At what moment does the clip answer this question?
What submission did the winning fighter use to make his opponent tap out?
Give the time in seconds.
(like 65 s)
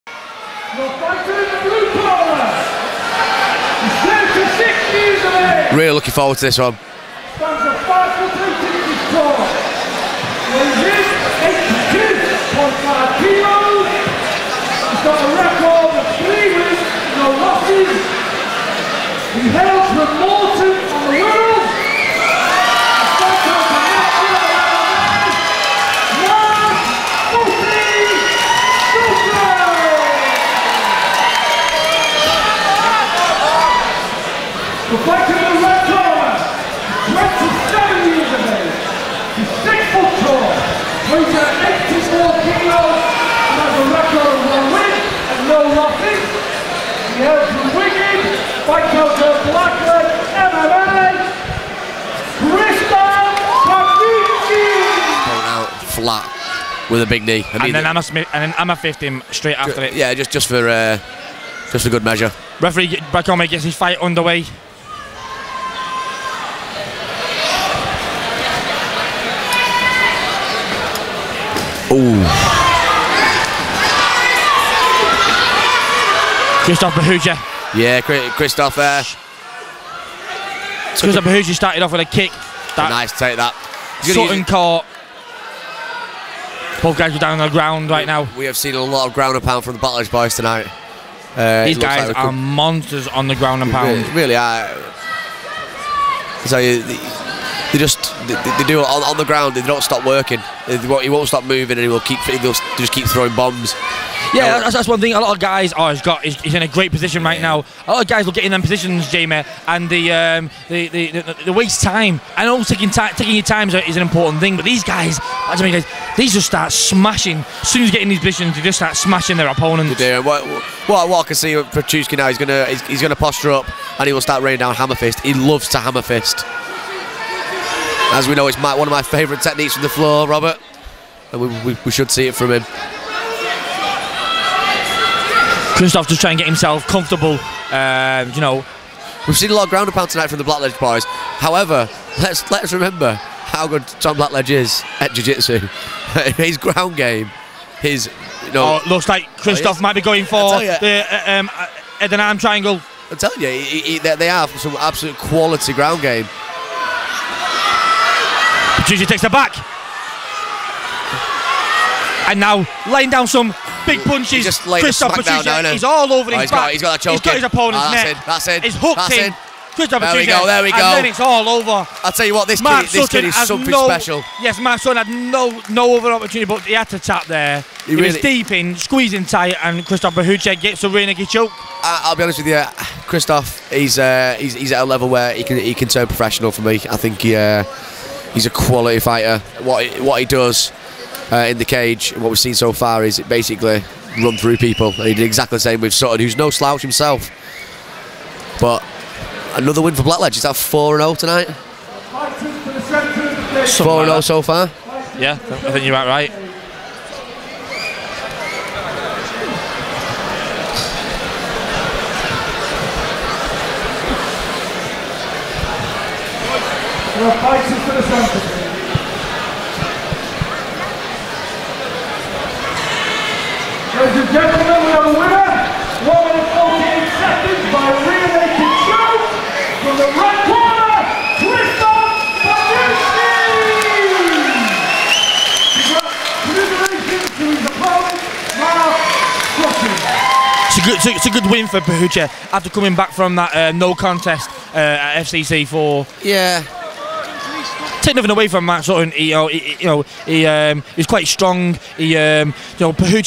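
180 s.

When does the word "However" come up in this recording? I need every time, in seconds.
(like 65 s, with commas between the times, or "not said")
141 s.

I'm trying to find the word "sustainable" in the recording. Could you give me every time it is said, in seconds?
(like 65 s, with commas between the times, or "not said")
not said.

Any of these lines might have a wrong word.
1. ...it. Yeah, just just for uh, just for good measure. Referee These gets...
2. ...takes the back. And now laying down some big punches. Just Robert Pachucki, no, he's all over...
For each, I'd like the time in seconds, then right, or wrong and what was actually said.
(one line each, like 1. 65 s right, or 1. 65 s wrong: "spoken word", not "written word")
1. 59 s wrong: "Bakome", not "These"
2. 159 s wrong: "Kristoff", not "Robert".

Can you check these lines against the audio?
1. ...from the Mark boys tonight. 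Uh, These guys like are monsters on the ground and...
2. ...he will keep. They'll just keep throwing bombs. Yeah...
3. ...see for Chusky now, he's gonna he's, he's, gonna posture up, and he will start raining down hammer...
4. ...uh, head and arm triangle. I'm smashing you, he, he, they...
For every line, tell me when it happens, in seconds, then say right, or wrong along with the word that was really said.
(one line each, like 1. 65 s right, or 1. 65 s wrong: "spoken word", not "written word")
1. 89 s wrong: "Battlers", not "Mark"
2. 101 s right
3. 121 s right
4. 151 s wrong: "telling", not "smashing".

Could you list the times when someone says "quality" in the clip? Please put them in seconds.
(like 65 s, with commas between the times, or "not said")
155 s, 188 s.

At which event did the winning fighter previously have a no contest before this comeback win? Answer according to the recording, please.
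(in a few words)
FCC4.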